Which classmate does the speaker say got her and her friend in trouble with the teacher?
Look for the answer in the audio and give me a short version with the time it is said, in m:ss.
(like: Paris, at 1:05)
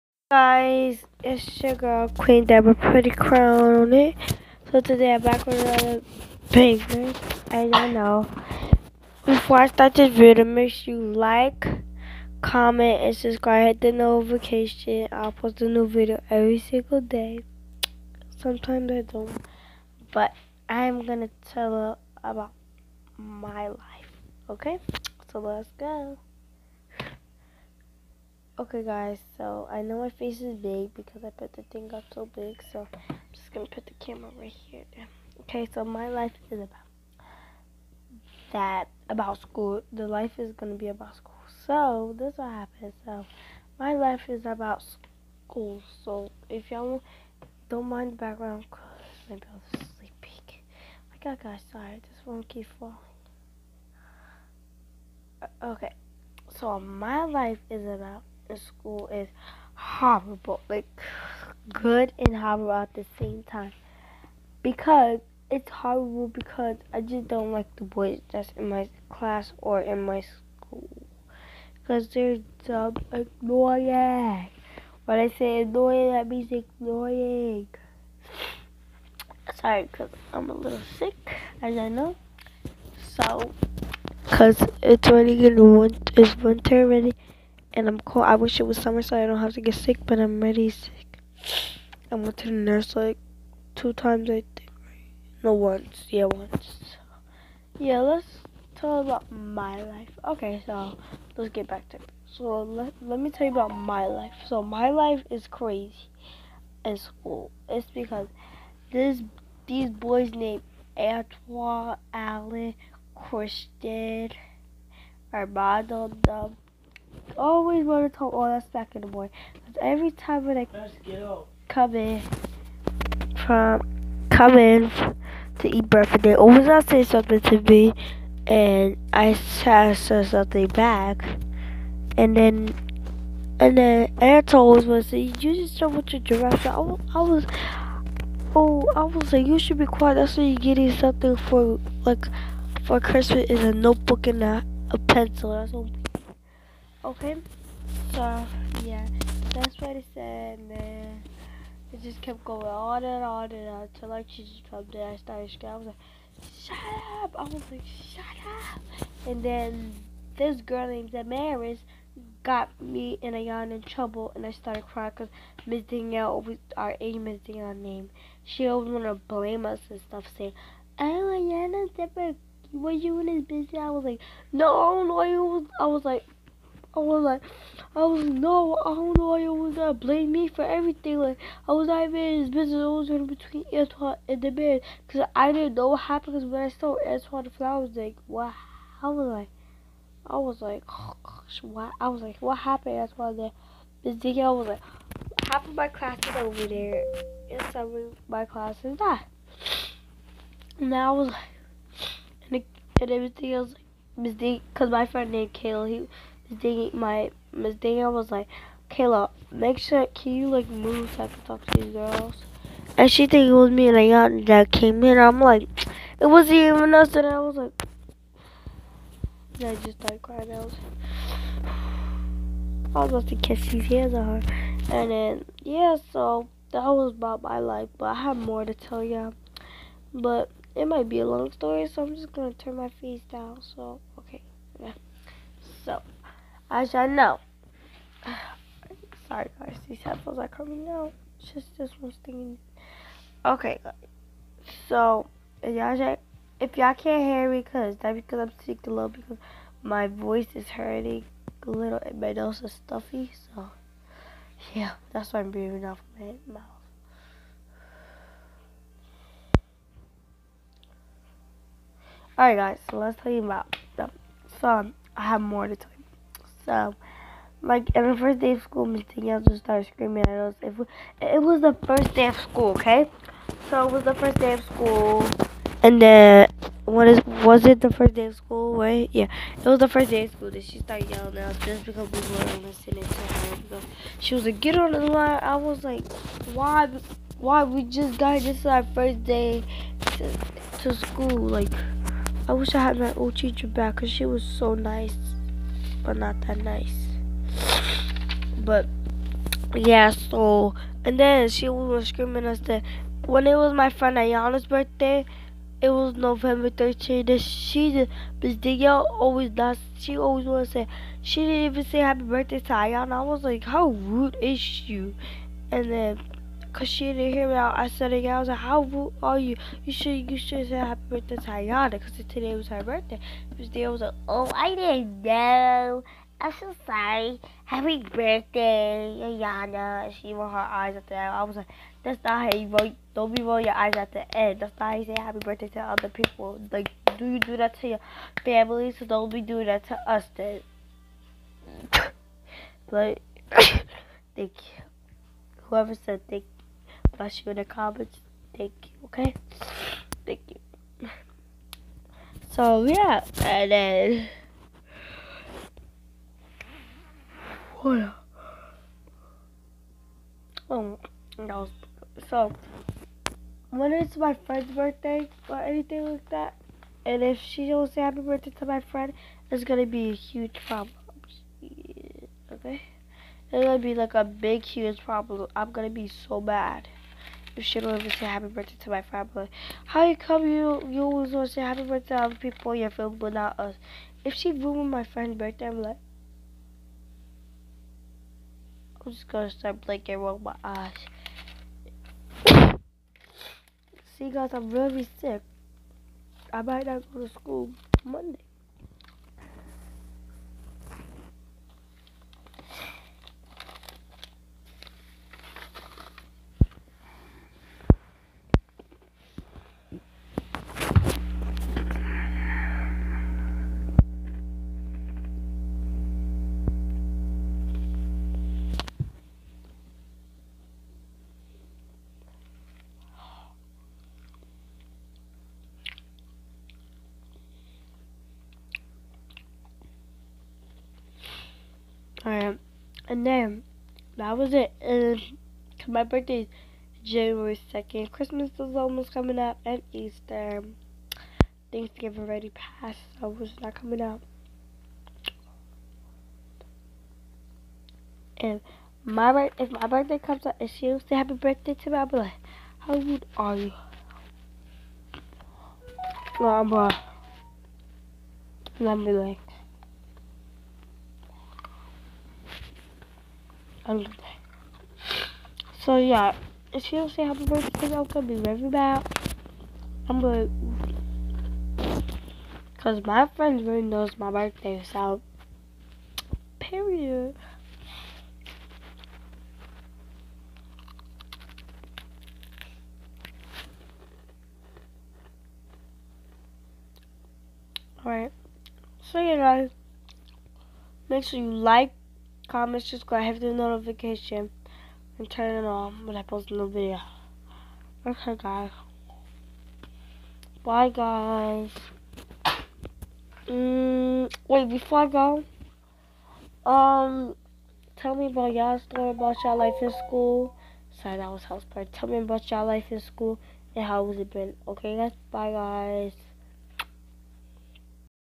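Damaris, at 2:41.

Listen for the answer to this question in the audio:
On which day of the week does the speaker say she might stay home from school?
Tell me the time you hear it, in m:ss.
6:38.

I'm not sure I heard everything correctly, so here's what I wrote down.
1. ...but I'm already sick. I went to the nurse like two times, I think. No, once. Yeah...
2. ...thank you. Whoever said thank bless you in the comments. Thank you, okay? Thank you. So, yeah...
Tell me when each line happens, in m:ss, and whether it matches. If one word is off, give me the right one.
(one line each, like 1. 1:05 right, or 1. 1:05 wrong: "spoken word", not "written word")
1. 1:30 right
2. 5:43 right.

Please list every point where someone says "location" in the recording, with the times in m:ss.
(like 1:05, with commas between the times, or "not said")
not said.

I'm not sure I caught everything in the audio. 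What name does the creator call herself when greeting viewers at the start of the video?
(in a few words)
Queen Debra Pretty Crown.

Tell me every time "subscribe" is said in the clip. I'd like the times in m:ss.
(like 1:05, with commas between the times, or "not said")
0:13, 8:12.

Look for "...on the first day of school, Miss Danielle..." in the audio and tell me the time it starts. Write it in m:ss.
4:27.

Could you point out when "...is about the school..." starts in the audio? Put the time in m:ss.
0:57.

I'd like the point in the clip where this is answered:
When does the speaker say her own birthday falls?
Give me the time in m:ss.
7:17.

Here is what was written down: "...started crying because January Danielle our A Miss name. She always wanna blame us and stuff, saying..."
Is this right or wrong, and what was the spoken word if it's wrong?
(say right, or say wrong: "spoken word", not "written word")
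wrong: "Miss", not "January".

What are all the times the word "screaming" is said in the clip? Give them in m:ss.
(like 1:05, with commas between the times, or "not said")
2:35, 4:29, 5:02.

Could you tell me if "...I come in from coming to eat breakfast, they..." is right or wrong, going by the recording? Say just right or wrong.
right.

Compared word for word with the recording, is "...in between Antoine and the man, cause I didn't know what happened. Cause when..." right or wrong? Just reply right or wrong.
right.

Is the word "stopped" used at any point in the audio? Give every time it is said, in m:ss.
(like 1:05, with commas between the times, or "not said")
2:34.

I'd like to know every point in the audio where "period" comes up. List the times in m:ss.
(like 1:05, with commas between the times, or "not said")
7:56.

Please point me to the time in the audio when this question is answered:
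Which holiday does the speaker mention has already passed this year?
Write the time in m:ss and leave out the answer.
7:21.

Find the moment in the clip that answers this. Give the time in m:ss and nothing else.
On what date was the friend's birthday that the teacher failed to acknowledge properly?
5:06.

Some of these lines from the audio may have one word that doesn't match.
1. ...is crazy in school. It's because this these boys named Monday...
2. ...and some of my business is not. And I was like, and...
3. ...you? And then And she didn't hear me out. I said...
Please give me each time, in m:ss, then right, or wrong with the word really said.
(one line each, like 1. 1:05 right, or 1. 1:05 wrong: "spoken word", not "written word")
1. 1:45 wrong: "Antoine", not "Monday"
2. 3:17 wrong: "class", not "business"
3. 5:14 wrong: "Cause", not "And".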